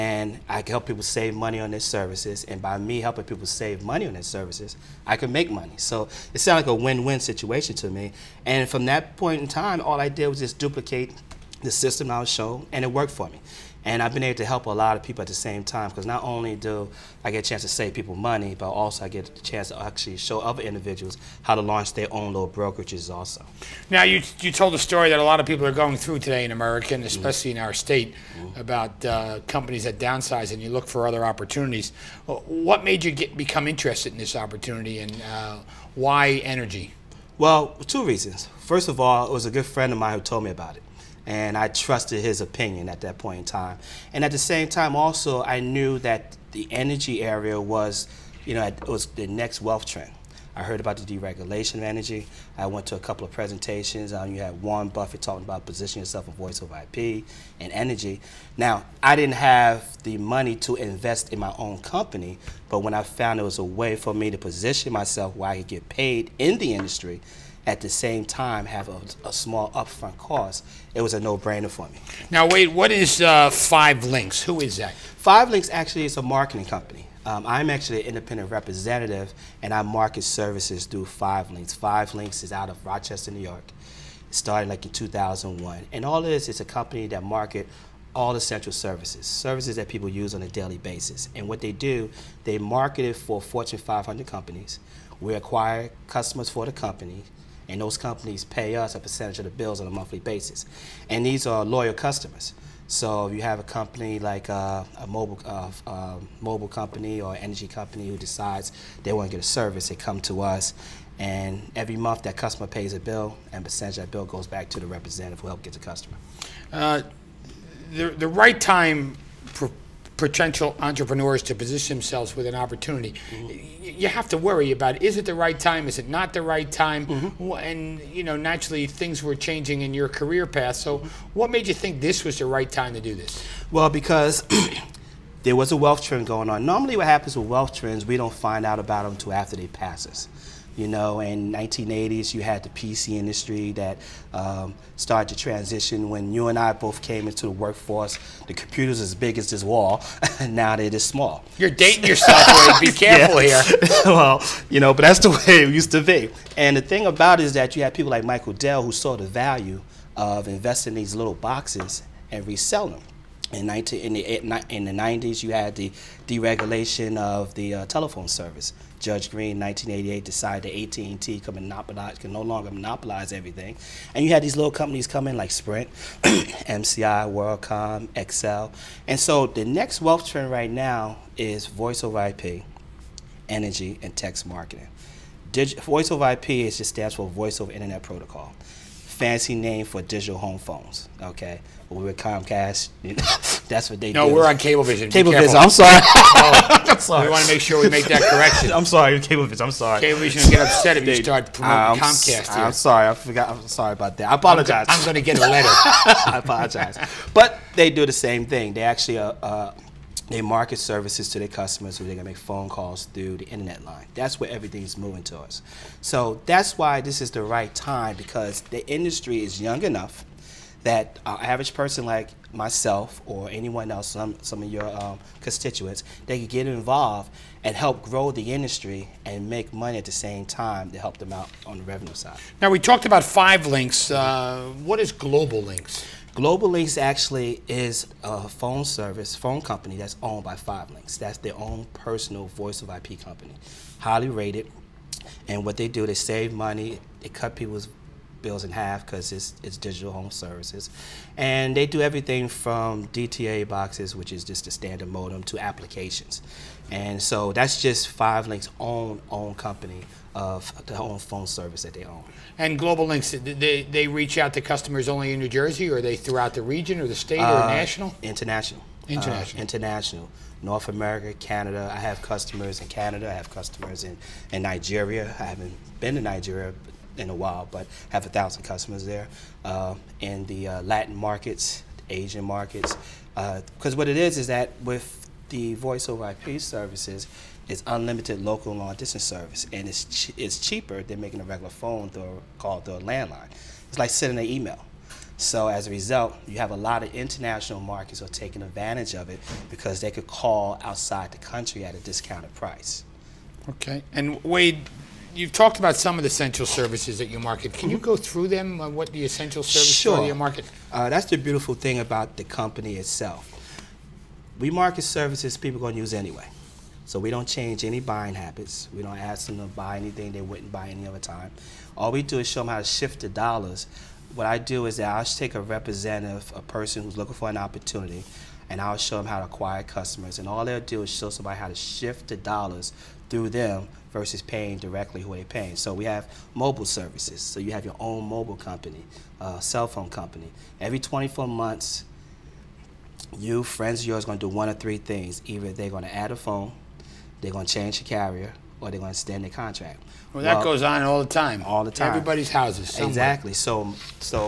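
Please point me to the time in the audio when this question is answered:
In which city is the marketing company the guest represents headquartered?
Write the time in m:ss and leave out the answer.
1:22.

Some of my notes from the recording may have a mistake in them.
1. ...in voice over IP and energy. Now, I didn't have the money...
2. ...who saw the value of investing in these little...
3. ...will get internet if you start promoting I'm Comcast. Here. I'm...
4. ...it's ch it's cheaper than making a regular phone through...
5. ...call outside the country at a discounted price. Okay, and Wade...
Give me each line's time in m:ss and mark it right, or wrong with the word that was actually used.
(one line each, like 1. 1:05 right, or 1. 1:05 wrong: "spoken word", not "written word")
1. 0:56 right
2. 2:38 right
3. 3:20 wrong: "upset", not "internet"
4. 4:49 right
5. 5:00 right.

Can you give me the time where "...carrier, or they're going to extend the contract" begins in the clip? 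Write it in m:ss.
5:48.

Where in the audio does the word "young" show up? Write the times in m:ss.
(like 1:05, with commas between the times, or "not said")
3:39.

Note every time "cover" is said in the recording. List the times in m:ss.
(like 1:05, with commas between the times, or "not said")
not said.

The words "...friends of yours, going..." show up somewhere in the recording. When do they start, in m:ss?
5:43.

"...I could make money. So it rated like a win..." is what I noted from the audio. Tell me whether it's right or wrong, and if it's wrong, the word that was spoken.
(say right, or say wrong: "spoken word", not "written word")
wrong: "sounded", not "rated".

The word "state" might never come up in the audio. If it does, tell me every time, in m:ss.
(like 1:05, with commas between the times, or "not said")
0:27, 4:27.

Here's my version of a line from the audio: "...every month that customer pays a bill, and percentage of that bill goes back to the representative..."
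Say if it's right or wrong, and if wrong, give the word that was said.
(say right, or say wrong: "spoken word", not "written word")
right.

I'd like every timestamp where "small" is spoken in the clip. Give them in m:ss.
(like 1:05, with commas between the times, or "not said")
1:09, 2:30.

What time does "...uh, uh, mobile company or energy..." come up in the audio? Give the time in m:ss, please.
1:45.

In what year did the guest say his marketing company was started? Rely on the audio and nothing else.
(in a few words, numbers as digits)
2001.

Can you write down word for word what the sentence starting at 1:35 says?
We acquire customers for the company and those companies pay us a percentage of the bills on a monthly basis.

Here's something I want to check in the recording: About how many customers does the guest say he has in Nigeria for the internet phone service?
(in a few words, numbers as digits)
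1000.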